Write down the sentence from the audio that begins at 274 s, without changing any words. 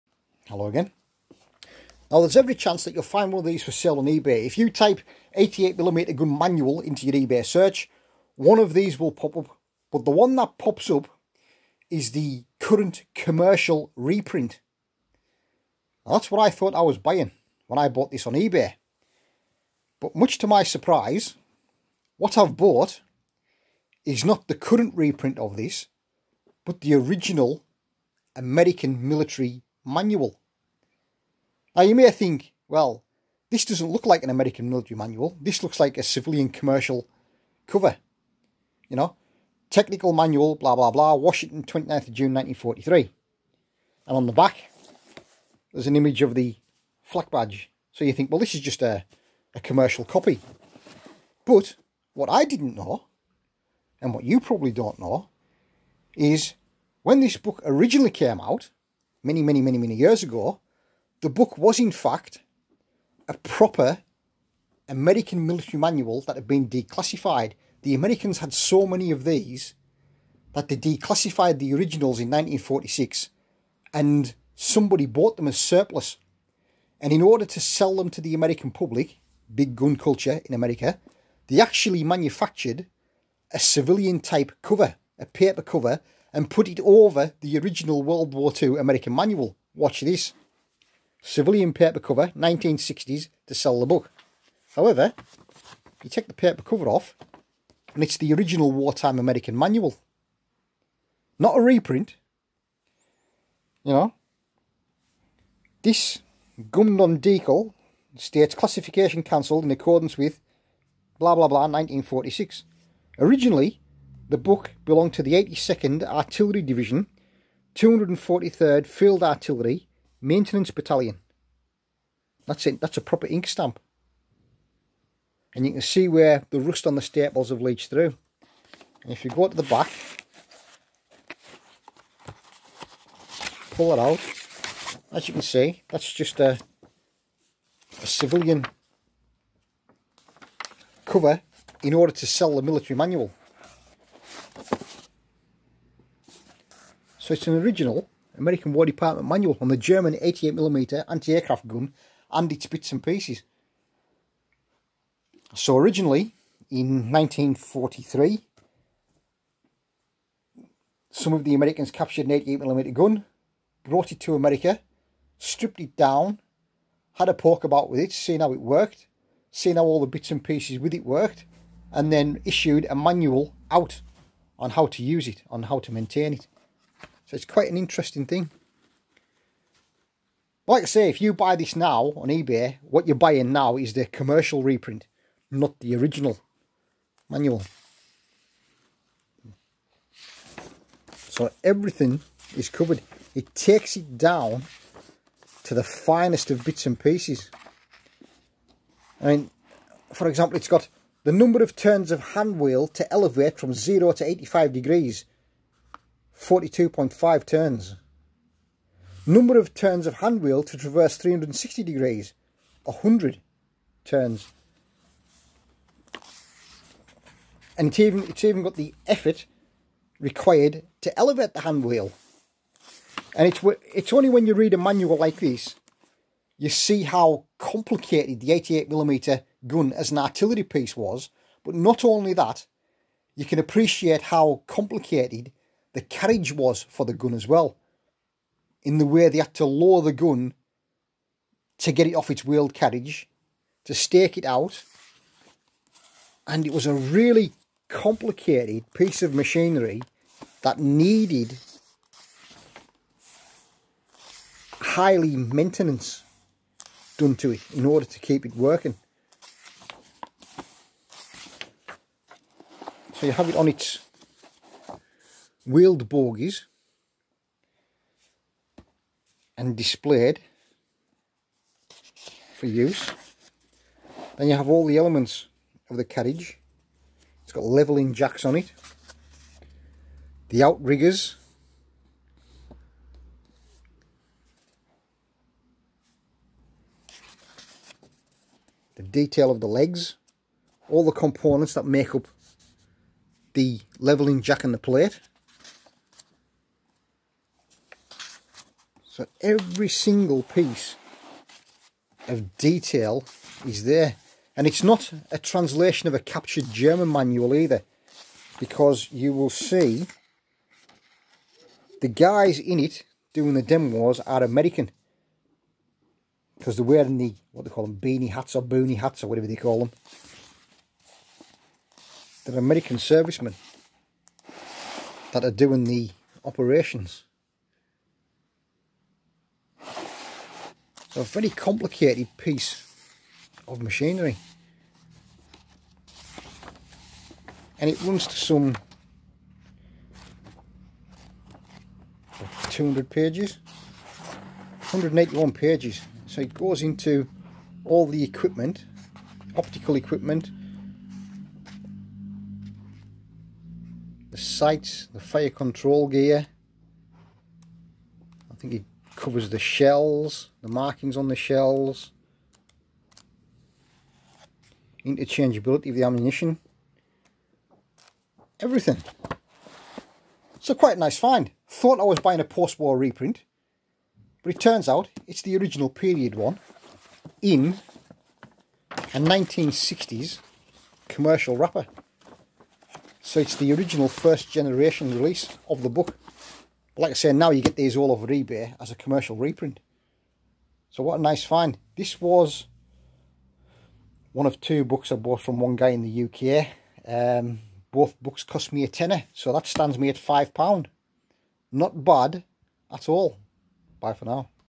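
Then you have all the elements of the carriage.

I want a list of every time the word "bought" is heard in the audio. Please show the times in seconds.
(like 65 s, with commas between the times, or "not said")
17 s, 22 s, 75 s, 395 s.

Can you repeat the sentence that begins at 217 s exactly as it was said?
And it's even, it's even got the effort required to elevate the handwheel.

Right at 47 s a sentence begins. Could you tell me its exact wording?
So you think, well, this is just a, a commercial copy.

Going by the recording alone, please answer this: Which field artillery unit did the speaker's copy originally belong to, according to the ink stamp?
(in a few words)
243rd Field Artillery.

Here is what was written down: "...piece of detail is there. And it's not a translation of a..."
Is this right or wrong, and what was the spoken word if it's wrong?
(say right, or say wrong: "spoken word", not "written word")
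right.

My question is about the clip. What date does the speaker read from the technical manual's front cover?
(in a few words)
29 June 1943.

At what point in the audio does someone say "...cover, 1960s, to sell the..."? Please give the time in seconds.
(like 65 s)
91 s.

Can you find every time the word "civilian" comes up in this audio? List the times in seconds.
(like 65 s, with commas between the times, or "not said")
36 s, 83 s, 91 s, 138 s.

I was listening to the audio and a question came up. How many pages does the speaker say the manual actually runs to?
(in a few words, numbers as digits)
181.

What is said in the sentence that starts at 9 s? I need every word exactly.
But the one that pops up is the current commercial reprint.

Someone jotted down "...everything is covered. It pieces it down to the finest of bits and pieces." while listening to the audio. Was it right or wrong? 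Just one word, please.
wrong.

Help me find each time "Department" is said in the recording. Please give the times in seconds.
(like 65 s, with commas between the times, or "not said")
148 s.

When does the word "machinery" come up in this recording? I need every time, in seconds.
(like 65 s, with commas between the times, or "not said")
249 s, 333 s.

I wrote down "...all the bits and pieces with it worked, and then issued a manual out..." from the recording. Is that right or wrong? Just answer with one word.
right.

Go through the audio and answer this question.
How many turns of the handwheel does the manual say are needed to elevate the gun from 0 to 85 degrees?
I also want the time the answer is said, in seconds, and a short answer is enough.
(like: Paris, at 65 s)
42.5, at 206 s.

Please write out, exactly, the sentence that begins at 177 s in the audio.
So it's quite an interesting thing.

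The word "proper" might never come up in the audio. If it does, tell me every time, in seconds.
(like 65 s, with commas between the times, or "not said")
63 s, 123 s.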